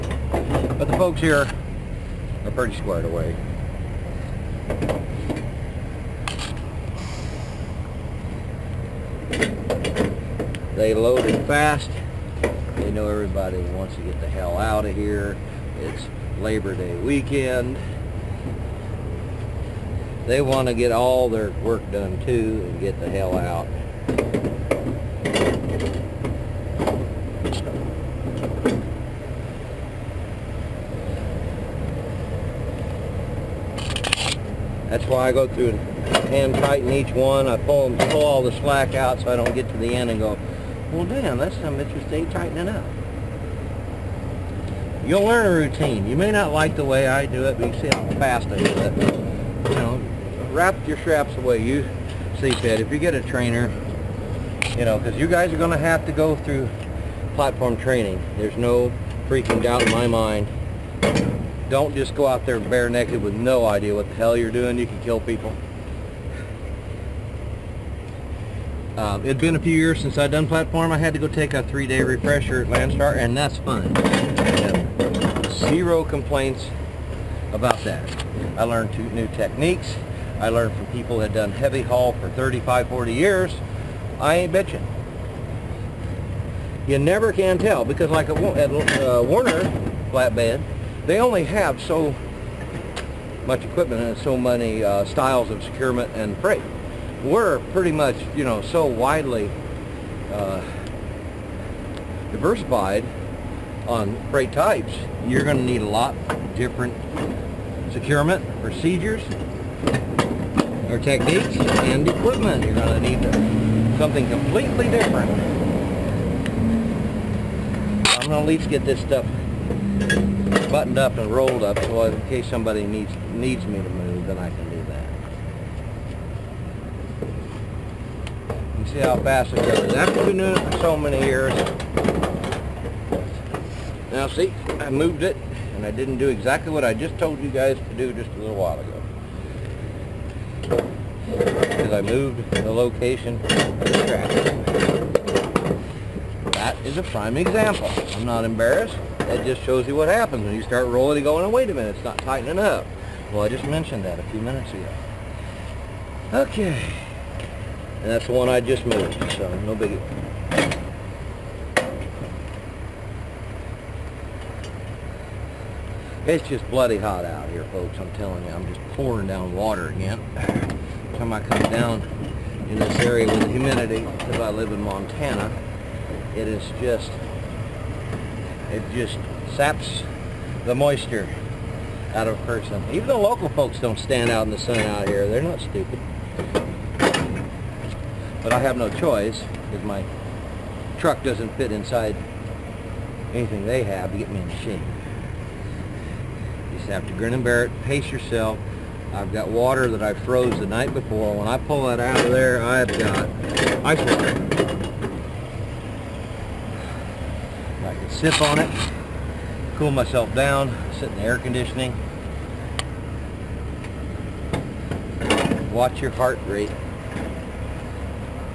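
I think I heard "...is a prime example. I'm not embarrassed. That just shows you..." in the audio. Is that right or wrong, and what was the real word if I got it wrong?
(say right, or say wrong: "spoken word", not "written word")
right.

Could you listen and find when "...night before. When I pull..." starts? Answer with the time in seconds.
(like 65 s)
200 s.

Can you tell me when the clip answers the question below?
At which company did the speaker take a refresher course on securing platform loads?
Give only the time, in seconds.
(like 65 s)
72 s.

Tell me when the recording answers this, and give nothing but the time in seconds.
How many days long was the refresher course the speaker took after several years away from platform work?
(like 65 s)
71 s.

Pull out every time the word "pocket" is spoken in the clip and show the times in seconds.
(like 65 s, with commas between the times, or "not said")
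not said.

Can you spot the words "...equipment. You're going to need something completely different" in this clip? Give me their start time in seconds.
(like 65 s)
112 s.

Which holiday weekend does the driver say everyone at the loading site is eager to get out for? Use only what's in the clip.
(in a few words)
Labor Day.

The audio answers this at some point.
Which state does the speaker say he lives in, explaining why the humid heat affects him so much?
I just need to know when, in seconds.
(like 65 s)
174 s.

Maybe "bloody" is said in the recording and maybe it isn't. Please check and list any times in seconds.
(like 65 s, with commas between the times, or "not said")
166 s.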